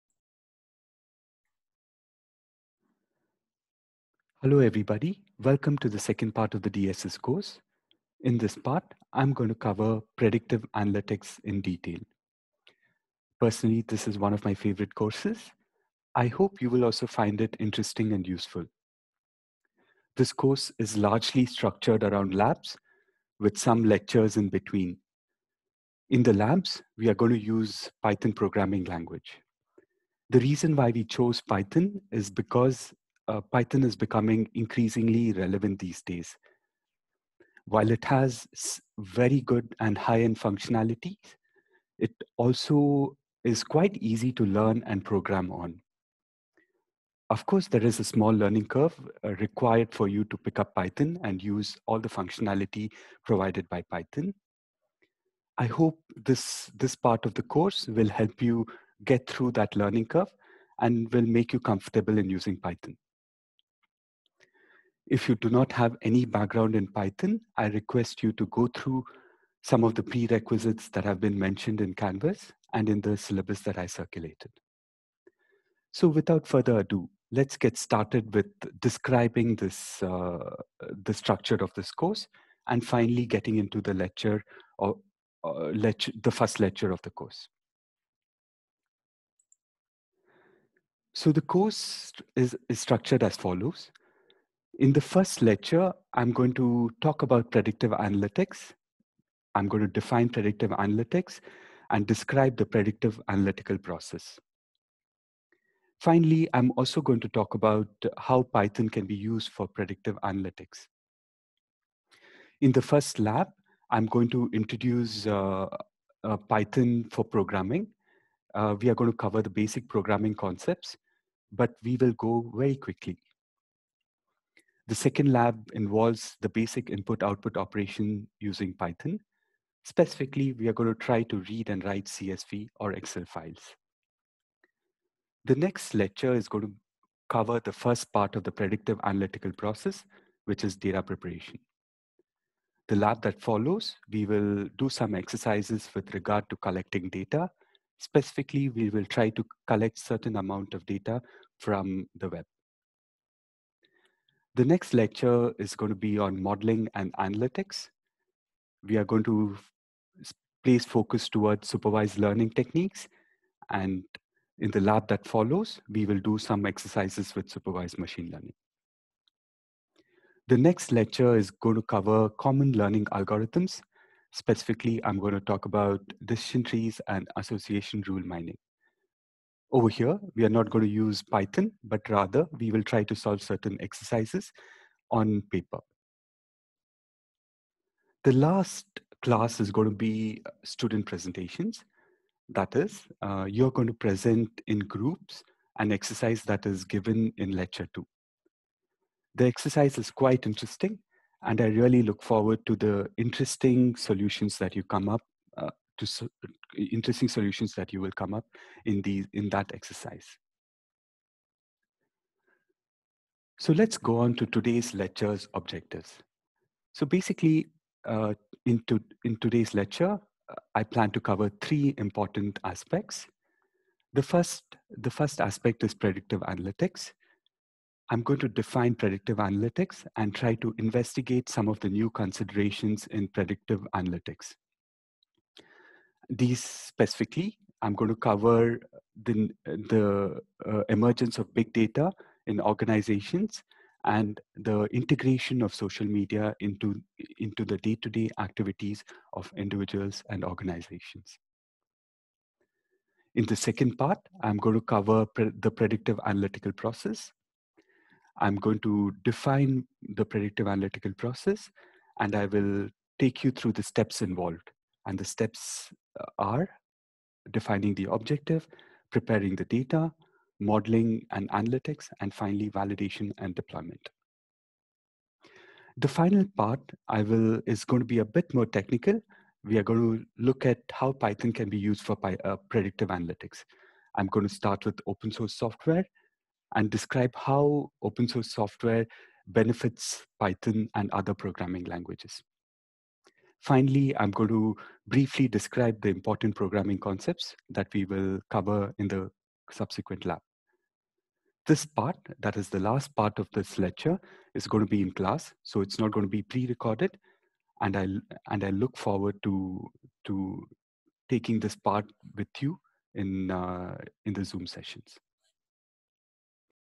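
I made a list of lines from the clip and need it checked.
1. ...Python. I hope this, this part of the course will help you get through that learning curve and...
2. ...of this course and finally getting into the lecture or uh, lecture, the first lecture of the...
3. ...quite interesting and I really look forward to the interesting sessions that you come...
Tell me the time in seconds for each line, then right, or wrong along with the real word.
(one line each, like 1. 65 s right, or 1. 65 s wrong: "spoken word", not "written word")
1. 53 s right
2. 81 s right
3. 200 s wrong: "solutions", not "sessions".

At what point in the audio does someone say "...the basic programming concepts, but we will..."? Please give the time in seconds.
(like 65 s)
119 s.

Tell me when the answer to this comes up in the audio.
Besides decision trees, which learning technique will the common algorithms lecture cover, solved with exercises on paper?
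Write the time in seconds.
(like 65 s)
177 s.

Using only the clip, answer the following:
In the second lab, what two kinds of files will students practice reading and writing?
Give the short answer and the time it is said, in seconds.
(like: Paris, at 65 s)
CSV or Excel, at 132 s.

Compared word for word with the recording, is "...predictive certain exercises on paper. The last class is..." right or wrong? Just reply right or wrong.
wrong.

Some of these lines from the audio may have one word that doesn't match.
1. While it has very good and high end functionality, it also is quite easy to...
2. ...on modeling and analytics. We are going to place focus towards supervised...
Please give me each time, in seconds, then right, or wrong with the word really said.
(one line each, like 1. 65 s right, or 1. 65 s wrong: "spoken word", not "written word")
1. 37 s right
2. 156 s right.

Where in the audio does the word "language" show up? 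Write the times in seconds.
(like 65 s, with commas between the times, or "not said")
28 s, 291 s.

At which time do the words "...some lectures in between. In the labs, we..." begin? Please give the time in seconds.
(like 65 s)
23 s.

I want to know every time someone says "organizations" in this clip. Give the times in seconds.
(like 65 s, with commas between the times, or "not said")
242 s, 250 s.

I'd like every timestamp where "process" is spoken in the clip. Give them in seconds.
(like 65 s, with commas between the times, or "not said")
103 s, 139 s, 256 s, 261 s.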